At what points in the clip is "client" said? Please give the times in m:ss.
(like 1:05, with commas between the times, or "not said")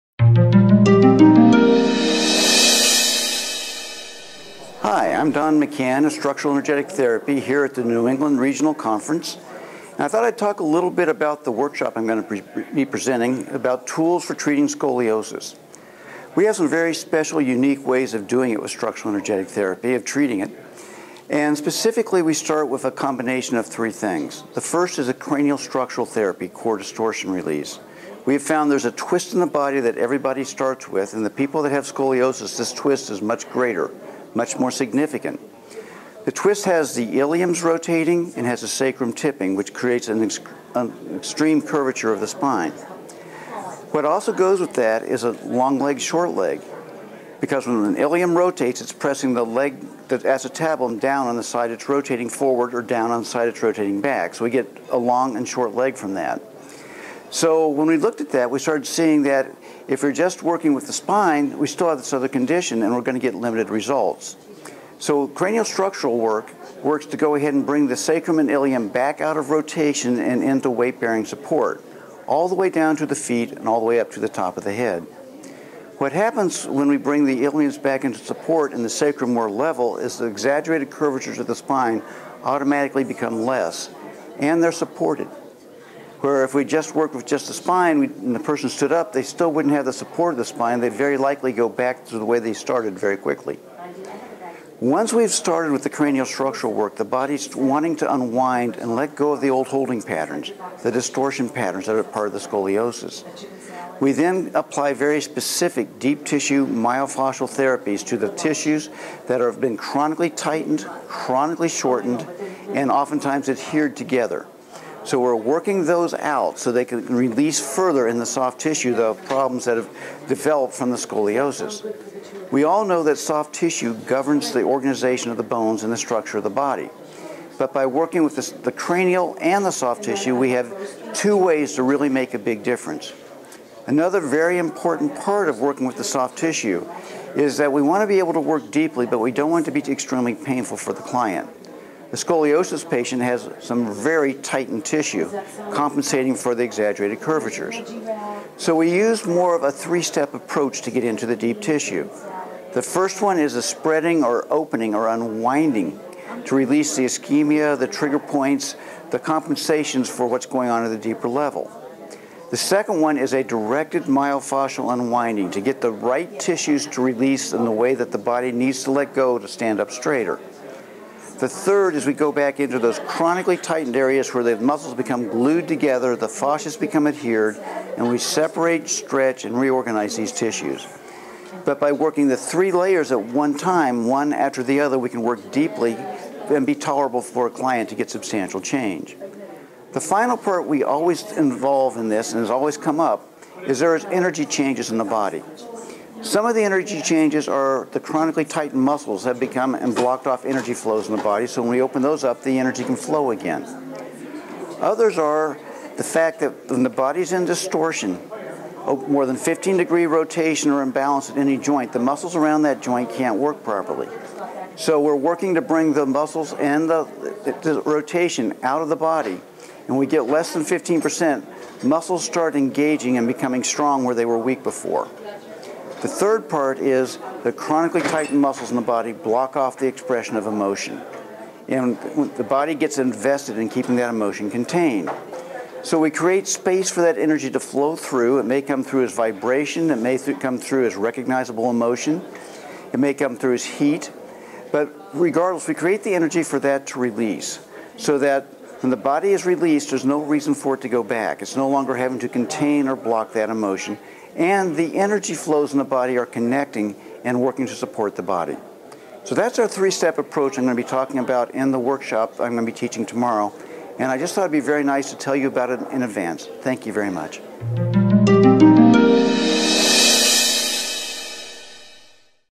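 2:21, 3:07.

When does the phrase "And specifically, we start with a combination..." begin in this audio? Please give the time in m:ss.
0:21.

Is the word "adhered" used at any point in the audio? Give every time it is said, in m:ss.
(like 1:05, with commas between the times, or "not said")
1:53, 2:57.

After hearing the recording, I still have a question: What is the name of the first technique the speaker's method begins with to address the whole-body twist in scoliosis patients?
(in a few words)
core distortion release.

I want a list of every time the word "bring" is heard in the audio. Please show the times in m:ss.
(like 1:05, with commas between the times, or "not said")
1:07, 1:16, 3:35.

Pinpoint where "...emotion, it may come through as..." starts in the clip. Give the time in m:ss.
4:01.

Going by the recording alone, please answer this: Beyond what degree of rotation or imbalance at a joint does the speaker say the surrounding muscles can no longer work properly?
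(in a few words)
15 degrees.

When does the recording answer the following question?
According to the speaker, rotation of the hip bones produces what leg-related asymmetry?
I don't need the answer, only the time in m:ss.
0:45.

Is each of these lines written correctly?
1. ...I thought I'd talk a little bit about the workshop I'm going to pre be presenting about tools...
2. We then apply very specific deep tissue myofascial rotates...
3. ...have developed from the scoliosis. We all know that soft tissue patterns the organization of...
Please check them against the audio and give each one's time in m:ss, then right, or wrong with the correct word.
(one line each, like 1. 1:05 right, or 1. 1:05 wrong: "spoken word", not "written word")
1. 0:10 right
2. 1:43 wrong: "therapies", not "rotates"
3. 1:59 wrong: "governs", not "patterns".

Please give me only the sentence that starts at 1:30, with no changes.
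They'd very likely go back to the way they started very quickly.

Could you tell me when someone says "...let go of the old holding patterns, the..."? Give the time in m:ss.
1:38.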